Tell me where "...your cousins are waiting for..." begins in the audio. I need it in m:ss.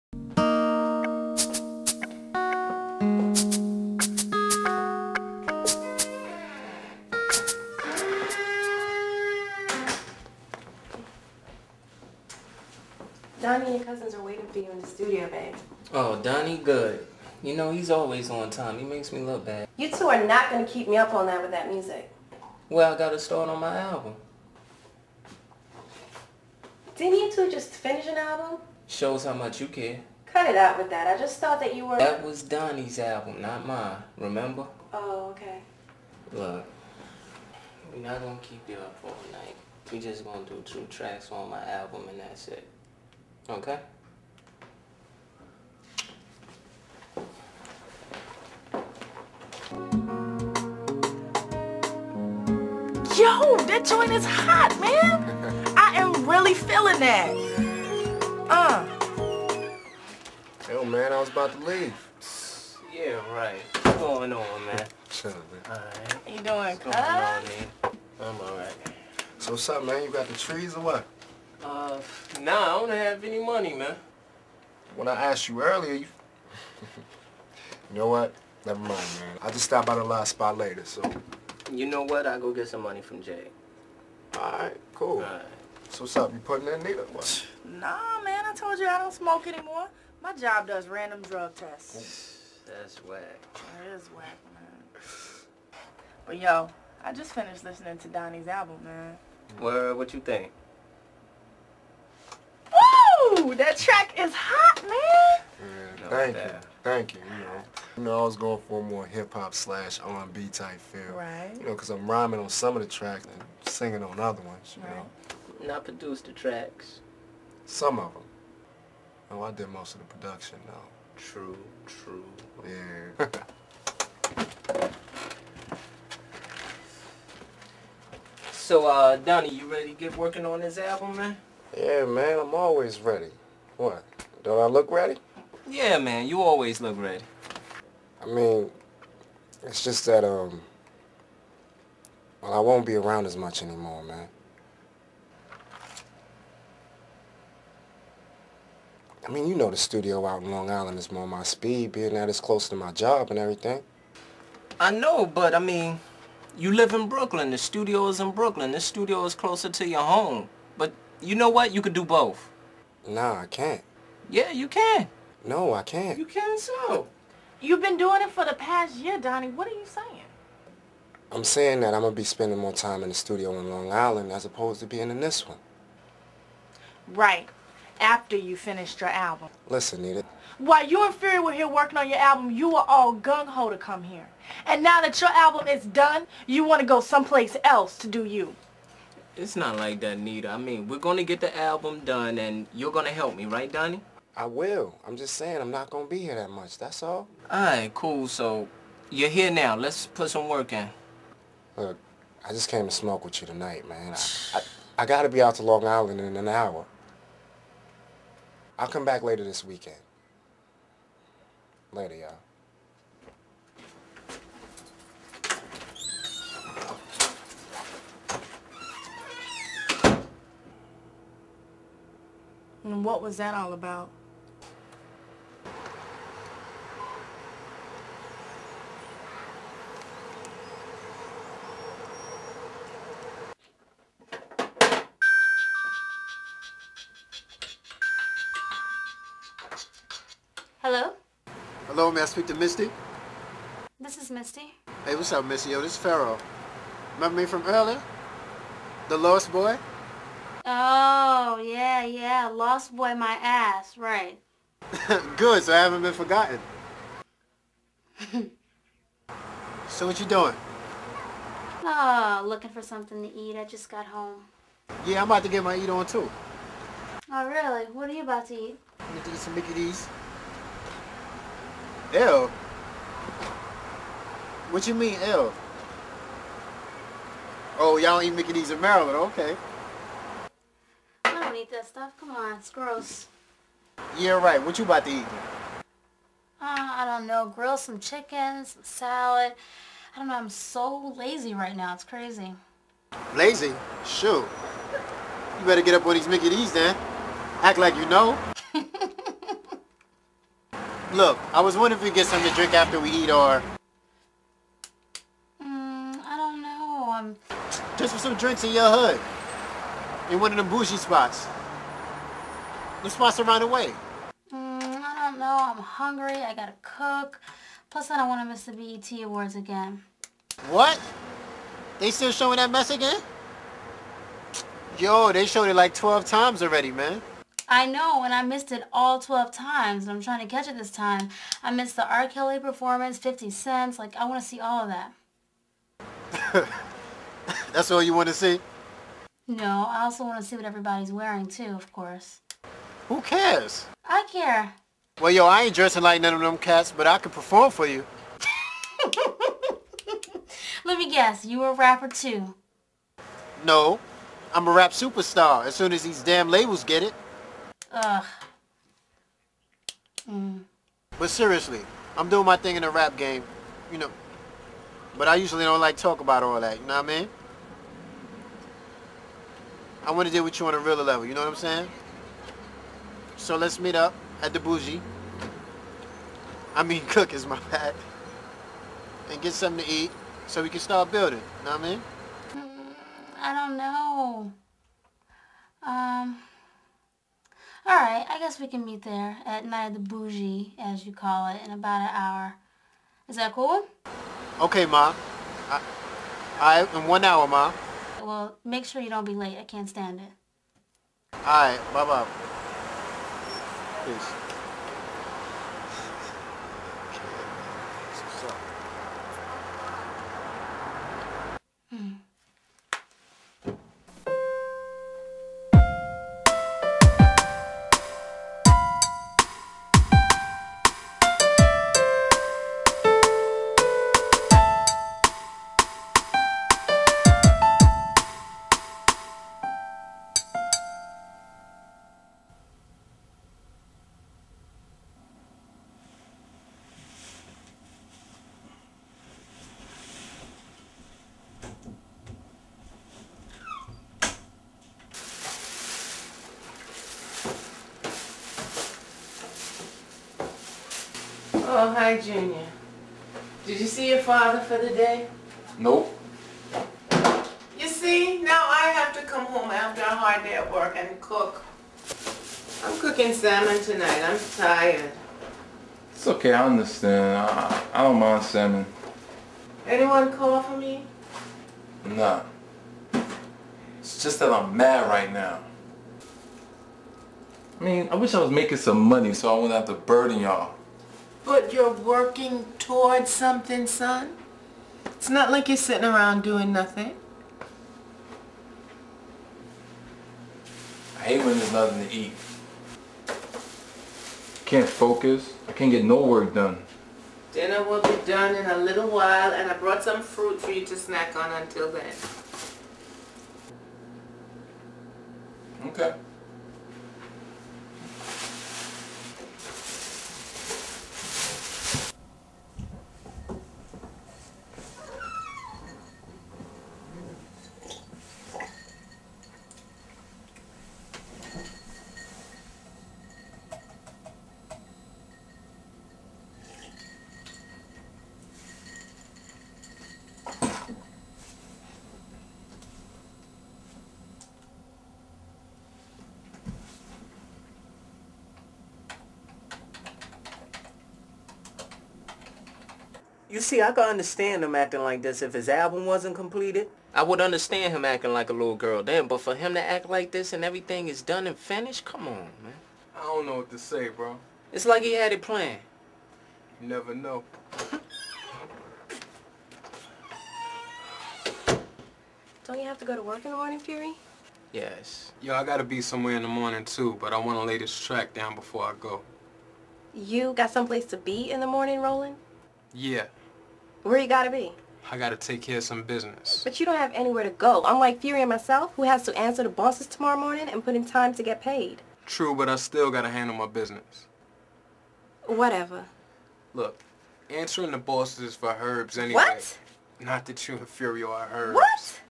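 0:13.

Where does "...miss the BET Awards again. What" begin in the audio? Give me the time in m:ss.
5:18.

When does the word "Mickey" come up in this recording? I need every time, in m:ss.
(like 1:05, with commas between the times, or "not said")
4:29, 4:38, 4:56.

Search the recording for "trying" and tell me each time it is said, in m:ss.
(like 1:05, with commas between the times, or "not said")
5:30.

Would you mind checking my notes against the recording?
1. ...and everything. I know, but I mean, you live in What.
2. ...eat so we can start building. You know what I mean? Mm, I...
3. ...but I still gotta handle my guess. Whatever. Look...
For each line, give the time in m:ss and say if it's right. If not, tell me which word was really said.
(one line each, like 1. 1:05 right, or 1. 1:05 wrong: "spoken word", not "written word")
1. 2:33 wrong: "Brooklyn", not "What"
2. 6:19 right
3. 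9:42 wrong: "business", not "guess".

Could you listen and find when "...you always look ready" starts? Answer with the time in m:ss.
2:16.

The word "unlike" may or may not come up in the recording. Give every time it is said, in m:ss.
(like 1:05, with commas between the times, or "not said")
9:37.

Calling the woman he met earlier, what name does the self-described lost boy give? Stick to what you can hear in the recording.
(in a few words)
Pharaoh.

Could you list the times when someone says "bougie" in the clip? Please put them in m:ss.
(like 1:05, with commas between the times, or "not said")
5:10, 6:14, 6:29.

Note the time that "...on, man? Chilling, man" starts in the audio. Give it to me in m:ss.
1:04.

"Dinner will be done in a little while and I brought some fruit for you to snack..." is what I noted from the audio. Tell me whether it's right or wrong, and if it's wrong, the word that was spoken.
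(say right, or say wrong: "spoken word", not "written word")
right.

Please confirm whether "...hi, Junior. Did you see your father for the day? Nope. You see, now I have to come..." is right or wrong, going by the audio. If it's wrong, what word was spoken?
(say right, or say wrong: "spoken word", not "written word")
right.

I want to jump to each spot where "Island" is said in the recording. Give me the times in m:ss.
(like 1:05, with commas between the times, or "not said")
2:30, 2:53, 3:25.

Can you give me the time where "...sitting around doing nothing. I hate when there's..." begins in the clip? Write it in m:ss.
8:05.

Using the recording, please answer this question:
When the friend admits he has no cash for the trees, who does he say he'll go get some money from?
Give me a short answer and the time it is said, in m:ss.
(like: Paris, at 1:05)
Jay, at 1:23.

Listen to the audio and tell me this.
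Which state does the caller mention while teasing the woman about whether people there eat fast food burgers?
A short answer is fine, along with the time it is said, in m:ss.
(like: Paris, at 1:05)
Maryland, at 4:38.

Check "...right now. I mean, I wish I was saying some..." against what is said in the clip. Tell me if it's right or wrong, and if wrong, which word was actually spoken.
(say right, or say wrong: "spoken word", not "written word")
wrong: "making", not "saying".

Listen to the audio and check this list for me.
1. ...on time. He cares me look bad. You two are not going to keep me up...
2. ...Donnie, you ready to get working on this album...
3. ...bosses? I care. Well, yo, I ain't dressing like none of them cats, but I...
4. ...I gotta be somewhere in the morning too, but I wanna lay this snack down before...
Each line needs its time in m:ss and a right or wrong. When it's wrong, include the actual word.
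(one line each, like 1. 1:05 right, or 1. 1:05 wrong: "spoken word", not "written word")
1. 0:18 wrong: "makes", not "cares"
2. 2:09 right
3. 5:43 wrong: "cares", not "bosses"
4. 9:25 wrong: "track", not "snack".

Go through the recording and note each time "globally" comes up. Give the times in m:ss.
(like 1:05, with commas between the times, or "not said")
not said.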